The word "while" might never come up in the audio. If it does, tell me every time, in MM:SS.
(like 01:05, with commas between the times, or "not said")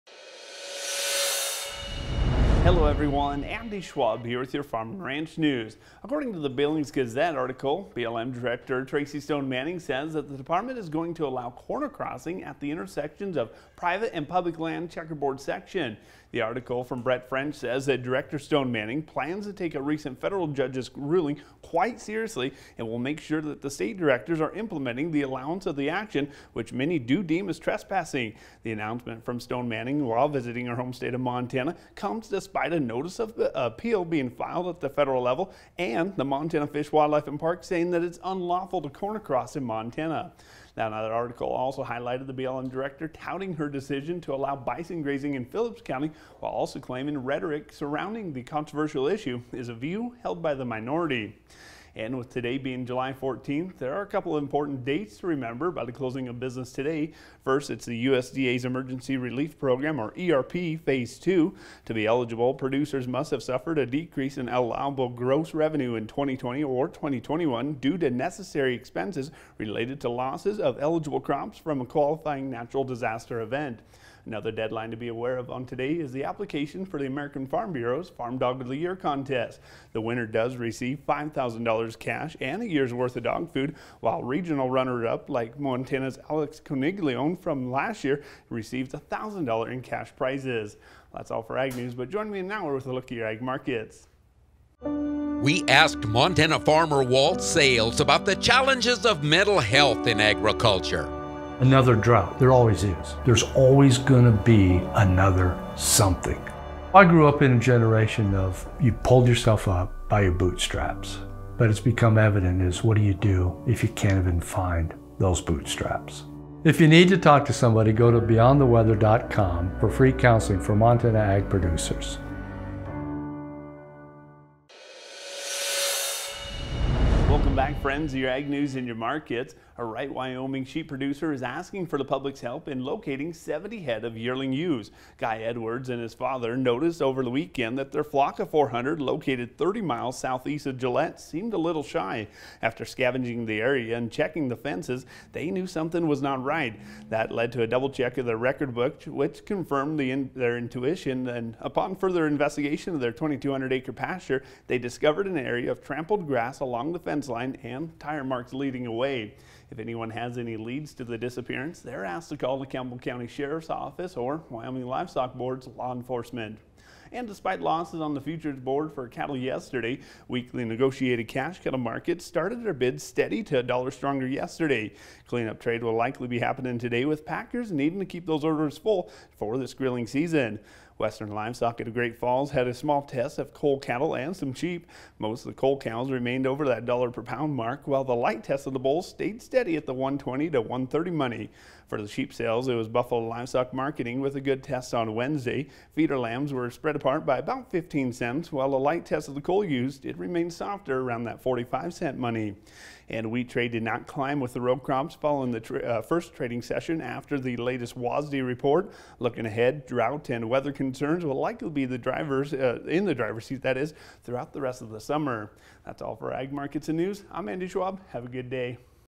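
00:30, 00:46, 01:24, 03:07, 03:18.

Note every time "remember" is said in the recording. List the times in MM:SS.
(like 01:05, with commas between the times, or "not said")
00:55.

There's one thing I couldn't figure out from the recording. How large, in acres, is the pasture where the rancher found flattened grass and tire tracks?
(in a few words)
2,200 acres.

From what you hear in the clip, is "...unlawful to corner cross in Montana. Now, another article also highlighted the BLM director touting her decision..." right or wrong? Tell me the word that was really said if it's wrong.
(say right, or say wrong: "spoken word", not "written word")
right.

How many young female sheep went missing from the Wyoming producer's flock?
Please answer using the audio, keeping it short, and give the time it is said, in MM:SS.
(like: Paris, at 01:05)
70, at 02:13.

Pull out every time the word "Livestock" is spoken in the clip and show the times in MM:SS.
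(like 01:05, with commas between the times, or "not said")
02:44, 03:01, 03:13.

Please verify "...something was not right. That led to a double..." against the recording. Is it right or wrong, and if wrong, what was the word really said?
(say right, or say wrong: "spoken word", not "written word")
right.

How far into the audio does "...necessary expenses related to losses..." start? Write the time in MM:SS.
01:08.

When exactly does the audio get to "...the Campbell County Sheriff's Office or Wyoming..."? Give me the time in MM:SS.
02:42.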